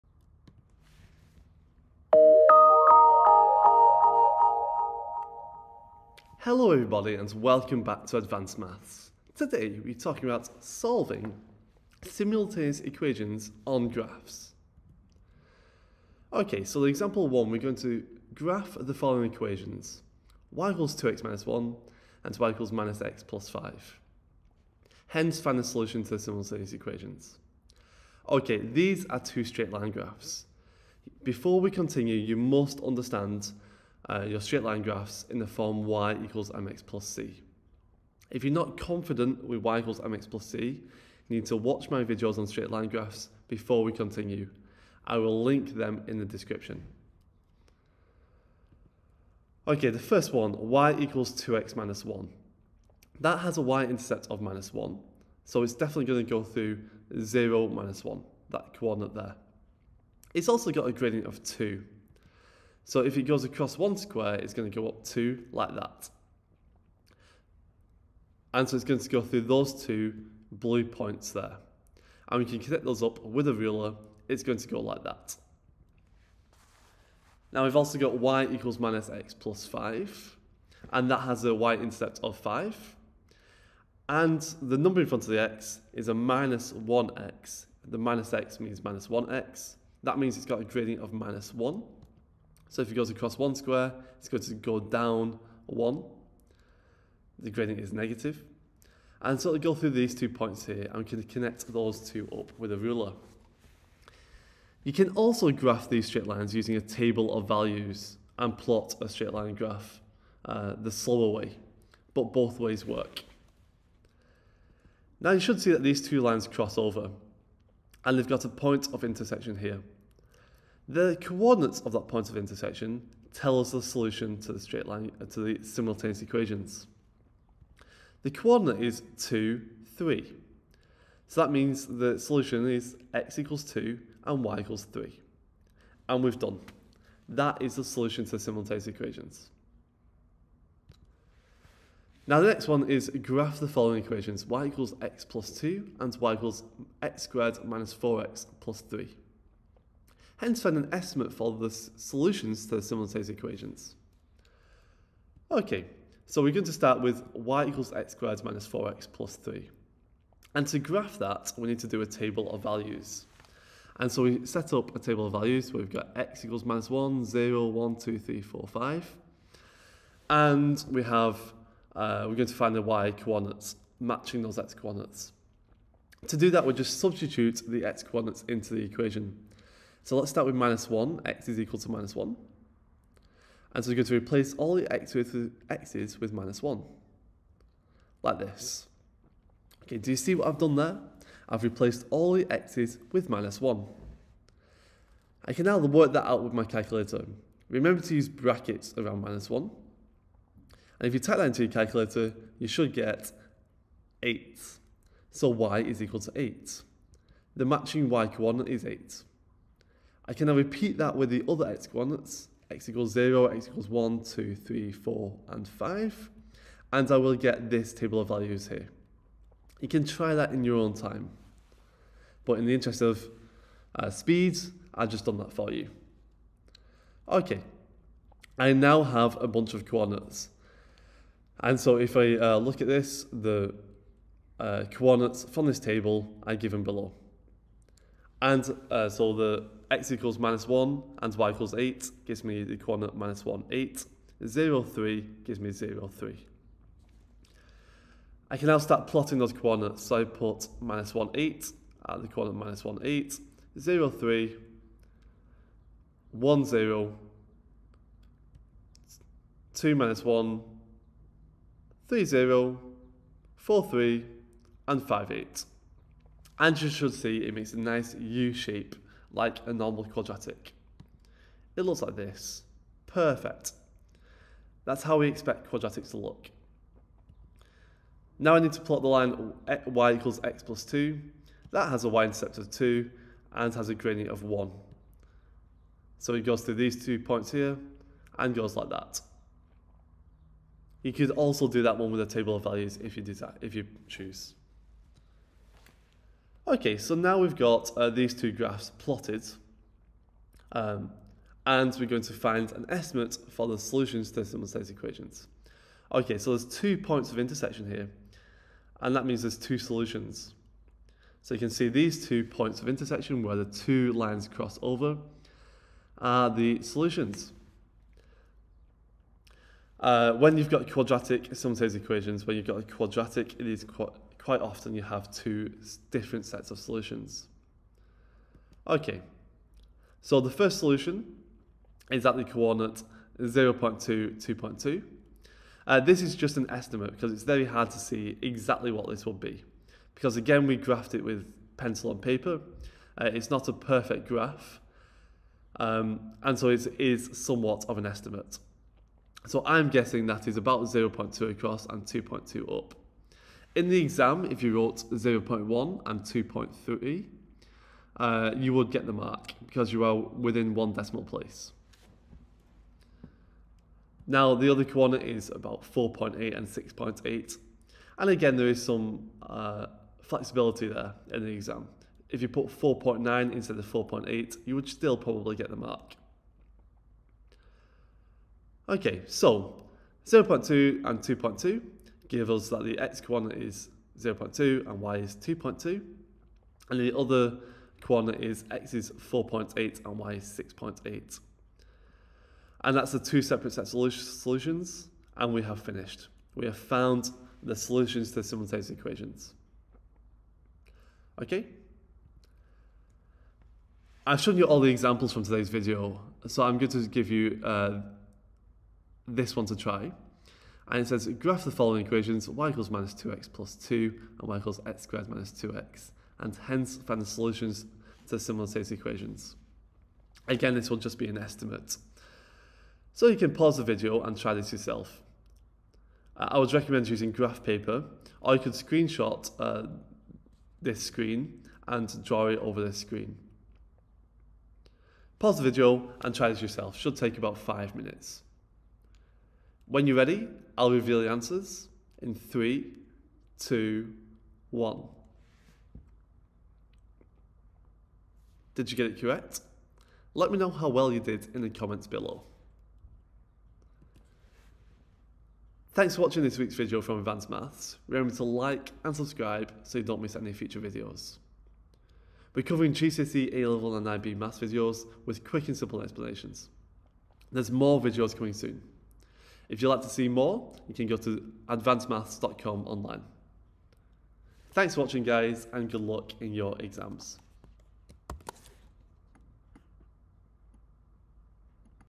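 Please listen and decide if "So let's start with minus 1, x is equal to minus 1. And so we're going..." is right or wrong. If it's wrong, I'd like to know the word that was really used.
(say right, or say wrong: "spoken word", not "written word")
right.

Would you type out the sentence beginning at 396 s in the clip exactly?
We have found the solutions to simultaneous equations.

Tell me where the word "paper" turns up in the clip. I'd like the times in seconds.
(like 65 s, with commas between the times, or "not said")
342 s, 427 s.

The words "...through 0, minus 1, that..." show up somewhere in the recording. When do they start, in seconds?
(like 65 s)
56 s.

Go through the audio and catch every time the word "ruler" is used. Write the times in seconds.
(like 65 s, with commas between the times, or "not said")
73 s, 102 s.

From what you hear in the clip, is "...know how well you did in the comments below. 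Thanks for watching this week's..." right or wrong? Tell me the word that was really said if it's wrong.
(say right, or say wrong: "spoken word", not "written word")
right.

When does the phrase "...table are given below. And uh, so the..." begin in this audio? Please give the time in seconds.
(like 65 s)
235 s.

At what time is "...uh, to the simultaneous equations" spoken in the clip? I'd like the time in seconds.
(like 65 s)
125 s.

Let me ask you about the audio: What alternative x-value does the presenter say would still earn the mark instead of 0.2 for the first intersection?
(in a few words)
0.1.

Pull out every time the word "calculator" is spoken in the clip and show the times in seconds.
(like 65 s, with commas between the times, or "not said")
196 s, 201 s.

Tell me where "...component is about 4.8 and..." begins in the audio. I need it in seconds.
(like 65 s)
364 s.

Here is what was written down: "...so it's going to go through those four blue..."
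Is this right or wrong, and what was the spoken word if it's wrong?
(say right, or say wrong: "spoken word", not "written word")
wrong: "two", not "four".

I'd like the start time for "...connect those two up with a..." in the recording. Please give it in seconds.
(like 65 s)
101 s.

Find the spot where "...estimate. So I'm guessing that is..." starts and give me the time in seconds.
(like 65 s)
348 s.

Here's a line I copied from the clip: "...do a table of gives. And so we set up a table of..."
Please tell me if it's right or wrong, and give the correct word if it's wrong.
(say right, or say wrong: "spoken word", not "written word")
wrong: "values", not "gives".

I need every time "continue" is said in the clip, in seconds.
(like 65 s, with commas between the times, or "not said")
31 s, 43 s.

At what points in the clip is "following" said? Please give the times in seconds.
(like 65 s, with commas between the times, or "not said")
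18 s, 143 s, 411 s.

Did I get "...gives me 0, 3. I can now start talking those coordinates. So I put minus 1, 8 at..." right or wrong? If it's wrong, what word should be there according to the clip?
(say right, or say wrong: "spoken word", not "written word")
wrong: "plotting", not "talking".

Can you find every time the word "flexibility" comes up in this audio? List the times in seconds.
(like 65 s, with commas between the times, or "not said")
370 s.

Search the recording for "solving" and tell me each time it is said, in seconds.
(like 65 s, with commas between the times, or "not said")
10 s.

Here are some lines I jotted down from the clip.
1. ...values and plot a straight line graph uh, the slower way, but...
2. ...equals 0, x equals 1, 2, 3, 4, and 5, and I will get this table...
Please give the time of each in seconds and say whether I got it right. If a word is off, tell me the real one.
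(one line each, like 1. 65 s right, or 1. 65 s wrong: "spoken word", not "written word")
1. 107 s right
2. 212 s right.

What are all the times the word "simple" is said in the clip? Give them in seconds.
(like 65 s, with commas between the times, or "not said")
465 s.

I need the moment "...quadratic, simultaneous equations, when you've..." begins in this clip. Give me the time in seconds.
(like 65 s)
320 s.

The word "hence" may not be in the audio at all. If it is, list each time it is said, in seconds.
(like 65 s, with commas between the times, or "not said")
25 s, 150 s, 416 s.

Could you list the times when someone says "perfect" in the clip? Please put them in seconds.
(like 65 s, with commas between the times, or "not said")
273 s, 343 s.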